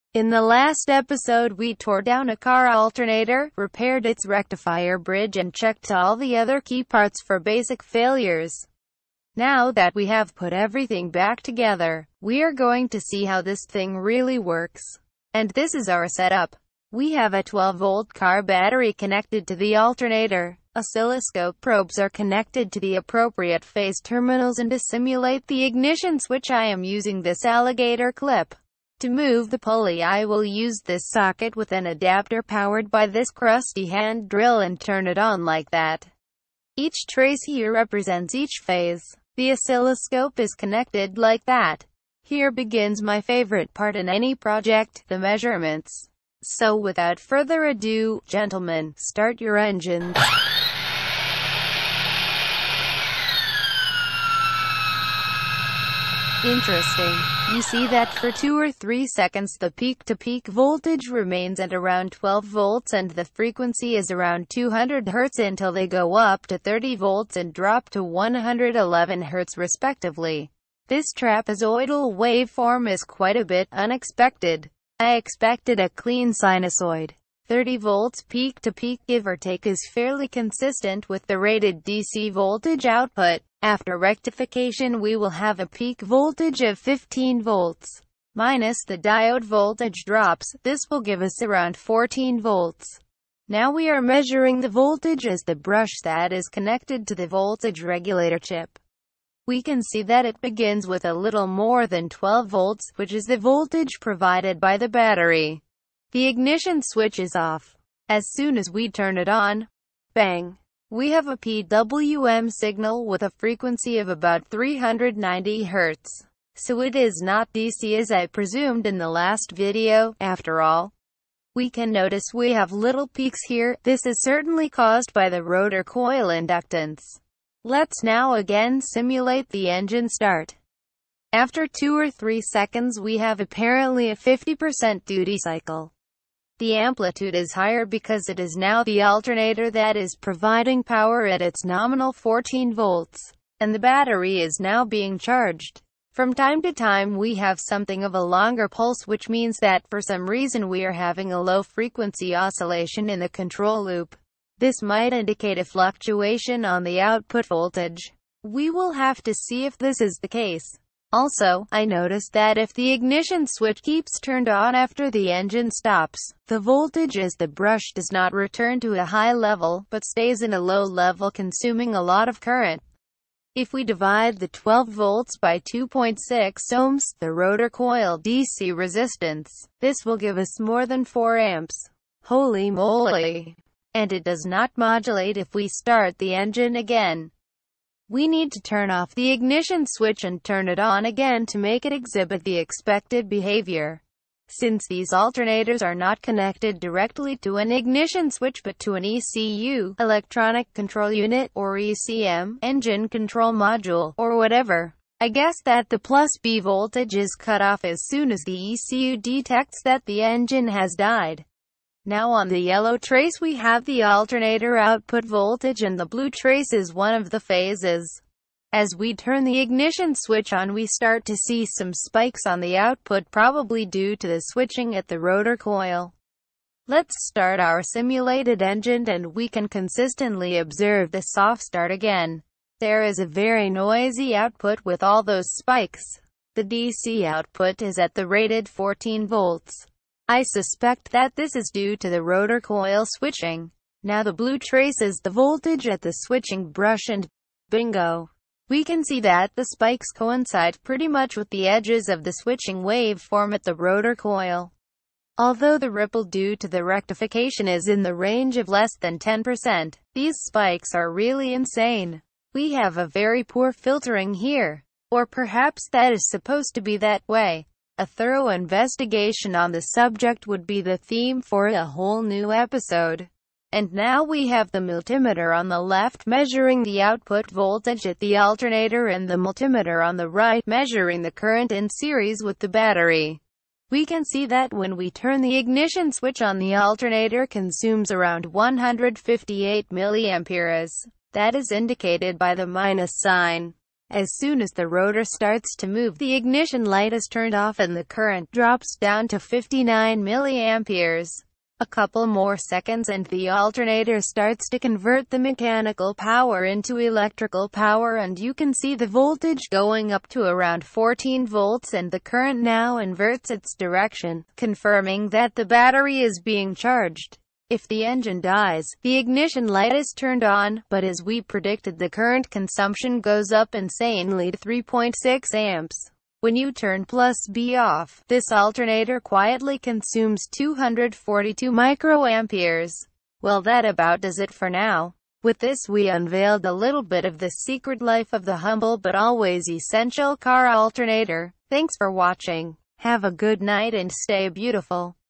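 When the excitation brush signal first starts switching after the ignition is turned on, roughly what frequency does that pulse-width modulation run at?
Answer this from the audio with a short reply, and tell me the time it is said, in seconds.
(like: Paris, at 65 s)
390 Hz, at 114 s.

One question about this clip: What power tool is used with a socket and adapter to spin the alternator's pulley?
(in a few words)
hand drill.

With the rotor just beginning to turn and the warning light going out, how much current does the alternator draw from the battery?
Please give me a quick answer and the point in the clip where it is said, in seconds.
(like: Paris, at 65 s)
59 milliamperes, at 299 s.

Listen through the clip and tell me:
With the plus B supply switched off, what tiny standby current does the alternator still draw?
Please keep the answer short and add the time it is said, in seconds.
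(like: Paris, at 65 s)
242 microamperes, at 330 s.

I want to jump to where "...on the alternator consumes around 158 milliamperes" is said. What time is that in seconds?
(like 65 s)
286 s.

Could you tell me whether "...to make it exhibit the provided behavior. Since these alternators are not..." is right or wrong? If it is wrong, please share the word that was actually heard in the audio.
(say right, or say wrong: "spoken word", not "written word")
wrong: "expected", not "provided".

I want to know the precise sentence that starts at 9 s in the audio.
Now that we have put everything back together, we are going to see how this thing really works.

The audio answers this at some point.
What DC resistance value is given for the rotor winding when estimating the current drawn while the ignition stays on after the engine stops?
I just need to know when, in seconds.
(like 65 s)
175 s.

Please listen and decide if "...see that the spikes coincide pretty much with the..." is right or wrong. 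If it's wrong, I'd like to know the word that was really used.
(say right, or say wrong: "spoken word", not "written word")
right.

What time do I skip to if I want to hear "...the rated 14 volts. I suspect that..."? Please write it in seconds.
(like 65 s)
238 s.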